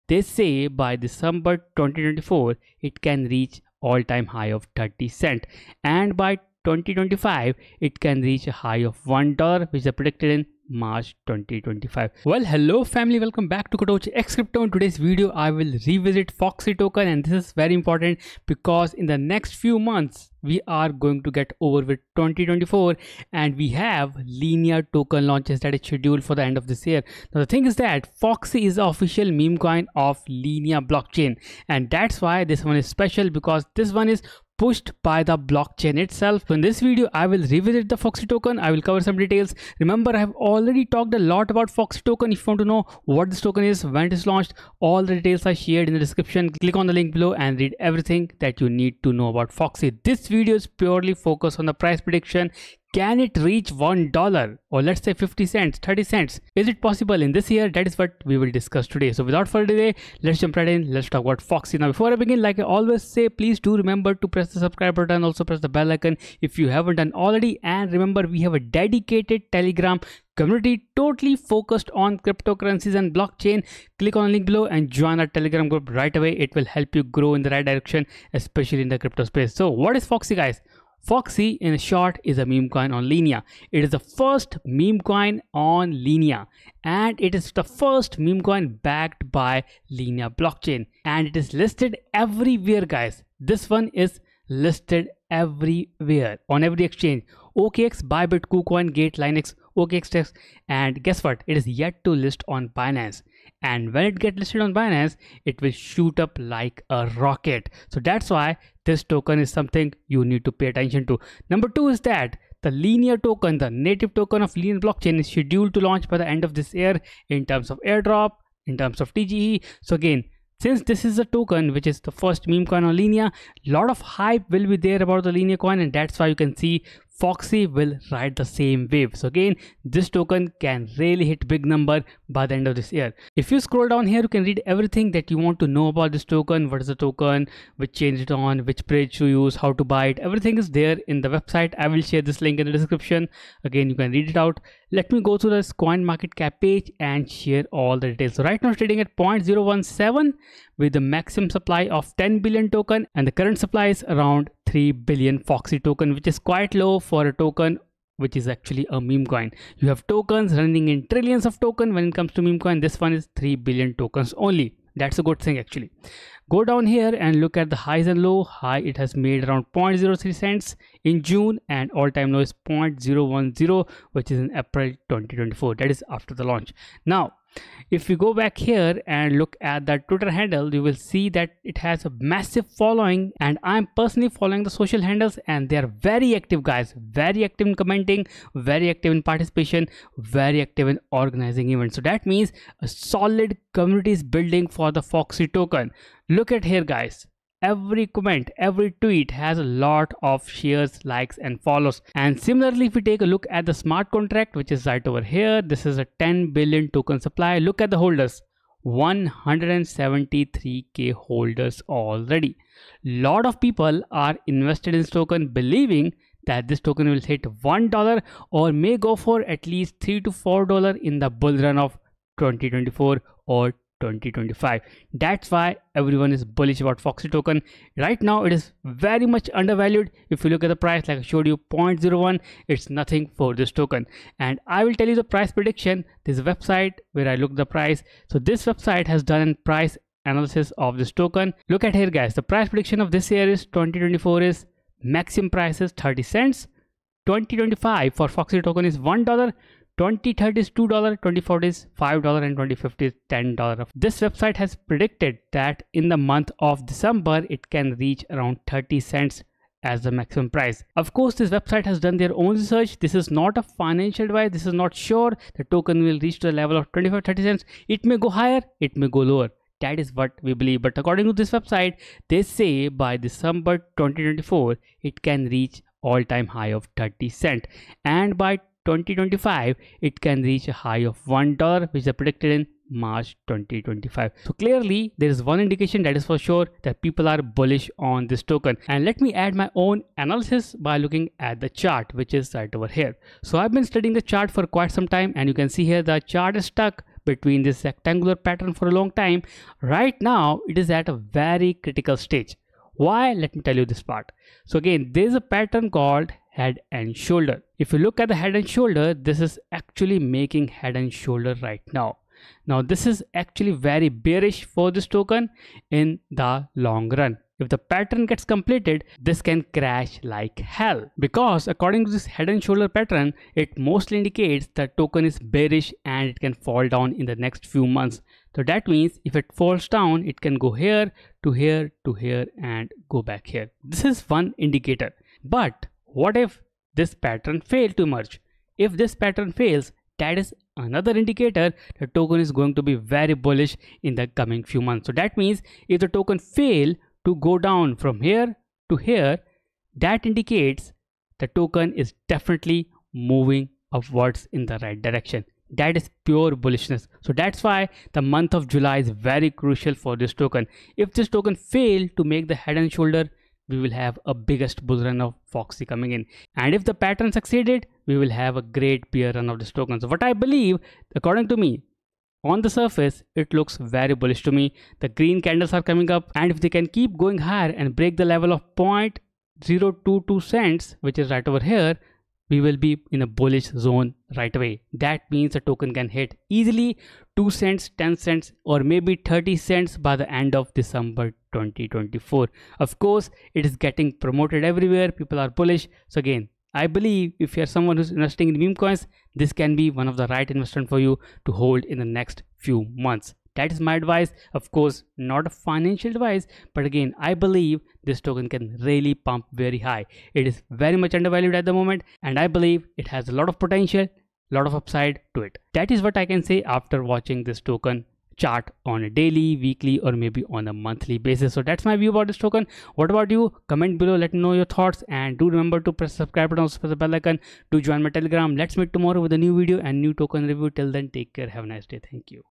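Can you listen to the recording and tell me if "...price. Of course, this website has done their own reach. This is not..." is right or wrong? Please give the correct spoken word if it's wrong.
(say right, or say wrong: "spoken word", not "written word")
wrong: "research", not "reach".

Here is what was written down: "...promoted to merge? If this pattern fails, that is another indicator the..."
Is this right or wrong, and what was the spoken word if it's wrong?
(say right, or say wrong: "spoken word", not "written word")
wrong: "failed", not "promoted".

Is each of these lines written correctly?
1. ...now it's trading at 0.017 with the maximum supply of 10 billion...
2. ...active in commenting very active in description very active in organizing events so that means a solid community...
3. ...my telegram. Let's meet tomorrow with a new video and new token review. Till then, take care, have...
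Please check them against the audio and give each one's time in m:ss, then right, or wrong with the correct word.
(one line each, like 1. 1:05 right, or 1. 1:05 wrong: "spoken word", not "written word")
1. 2:28 right
2. 3:07 wrong: "participation", not "description"
3. 7:08 right.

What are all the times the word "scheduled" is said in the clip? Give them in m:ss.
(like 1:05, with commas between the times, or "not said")
0:25, 1:55.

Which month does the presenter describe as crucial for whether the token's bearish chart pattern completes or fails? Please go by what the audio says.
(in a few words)
July.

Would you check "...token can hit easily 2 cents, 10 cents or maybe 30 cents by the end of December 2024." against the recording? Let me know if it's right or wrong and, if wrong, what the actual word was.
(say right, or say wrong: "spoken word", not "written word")
right.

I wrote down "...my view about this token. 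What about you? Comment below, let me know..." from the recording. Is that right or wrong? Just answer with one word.
right.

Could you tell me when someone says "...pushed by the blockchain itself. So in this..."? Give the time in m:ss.
0:34.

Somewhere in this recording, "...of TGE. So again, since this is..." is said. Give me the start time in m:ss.
1:59.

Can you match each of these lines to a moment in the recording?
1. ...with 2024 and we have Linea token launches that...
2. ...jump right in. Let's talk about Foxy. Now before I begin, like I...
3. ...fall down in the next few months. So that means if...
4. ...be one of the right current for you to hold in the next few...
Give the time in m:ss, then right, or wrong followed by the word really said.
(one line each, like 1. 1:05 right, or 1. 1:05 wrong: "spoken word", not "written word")
1. 0:21 right
2. 1:00 right
3. 5:26 right
4. 6:39 wrong: "investment", not "current".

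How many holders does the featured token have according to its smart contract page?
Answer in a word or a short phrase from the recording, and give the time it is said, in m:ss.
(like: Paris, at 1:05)
173k, at 3:28.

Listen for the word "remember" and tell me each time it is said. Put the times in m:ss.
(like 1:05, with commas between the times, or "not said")
0:39, 1:03, 1:07, 7:05.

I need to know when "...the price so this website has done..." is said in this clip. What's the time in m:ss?
3:57.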